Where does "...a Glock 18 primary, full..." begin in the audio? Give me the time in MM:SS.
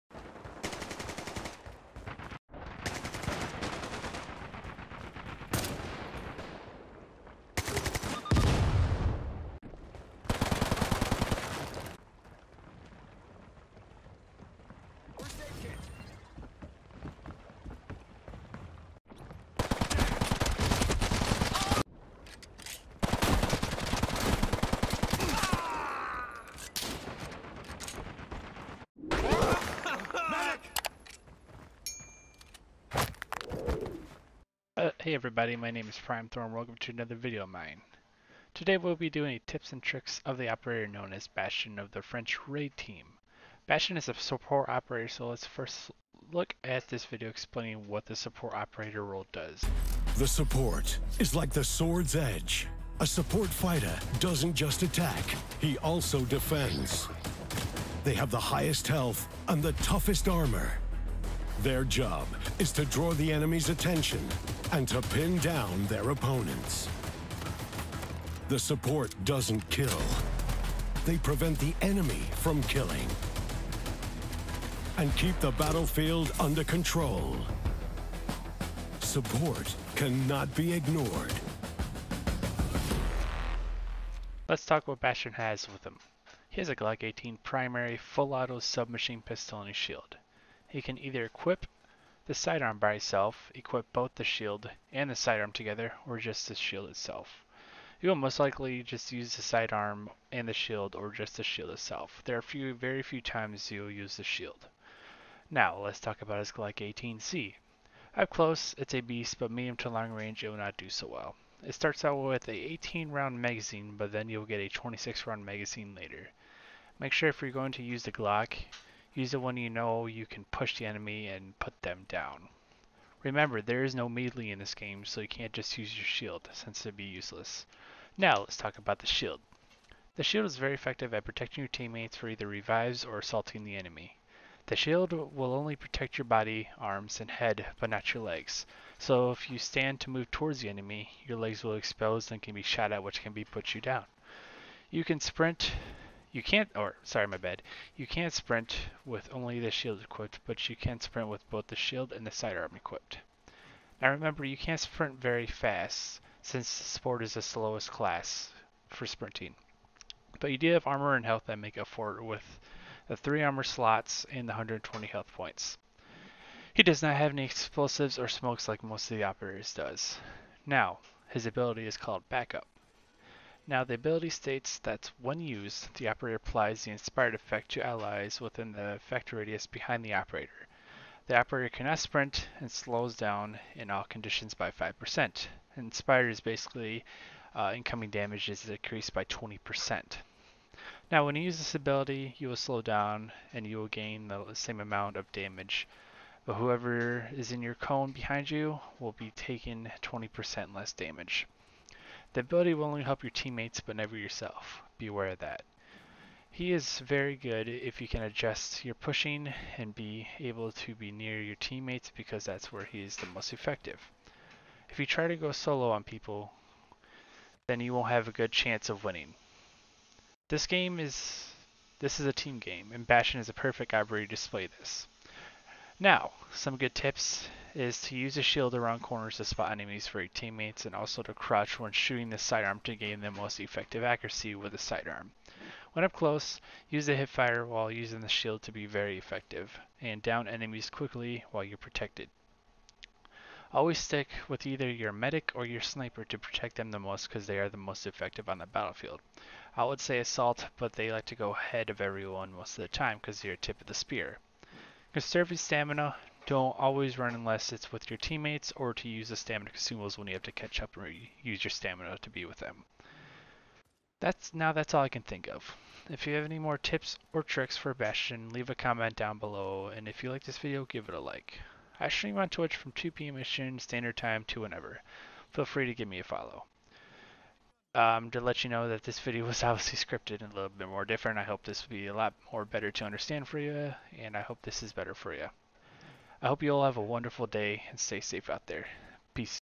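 01:26.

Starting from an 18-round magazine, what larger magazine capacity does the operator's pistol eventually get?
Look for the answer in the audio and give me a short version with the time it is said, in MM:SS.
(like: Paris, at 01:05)
26, at 01:54.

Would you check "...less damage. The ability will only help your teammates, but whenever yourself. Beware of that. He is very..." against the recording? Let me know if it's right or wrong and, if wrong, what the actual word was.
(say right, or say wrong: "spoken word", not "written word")
wrong: "never", not "whenever".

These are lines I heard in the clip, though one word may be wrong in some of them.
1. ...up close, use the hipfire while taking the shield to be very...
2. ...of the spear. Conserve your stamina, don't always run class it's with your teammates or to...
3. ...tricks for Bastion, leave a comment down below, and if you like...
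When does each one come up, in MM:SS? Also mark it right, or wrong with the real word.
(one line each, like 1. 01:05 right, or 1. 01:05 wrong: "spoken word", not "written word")
1. 03:56 wrong: "using", not "taking"
2. 04:13 wrong: "unless", not "class"
3. 04:27 right.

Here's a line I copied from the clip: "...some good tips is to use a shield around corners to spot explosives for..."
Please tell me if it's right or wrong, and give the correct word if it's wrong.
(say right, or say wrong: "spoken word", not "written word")
wrong: "enemies", not "explosives".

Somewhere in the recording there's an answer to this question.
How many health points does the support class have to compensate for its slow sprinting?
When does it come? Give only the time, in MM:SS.
02:44.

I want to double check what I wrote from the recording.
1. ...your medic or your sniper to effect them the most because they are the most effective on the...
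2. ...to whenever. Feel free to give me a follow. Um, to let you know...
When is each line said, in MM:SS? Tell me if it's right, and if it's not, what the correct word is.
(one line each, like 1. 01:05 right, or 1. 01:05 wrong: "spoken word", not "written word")
1. 04:04 wrong: "protect", not "effect"
2. 04:34 right.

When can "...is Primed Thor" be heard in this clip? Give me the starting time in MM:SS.
00:35.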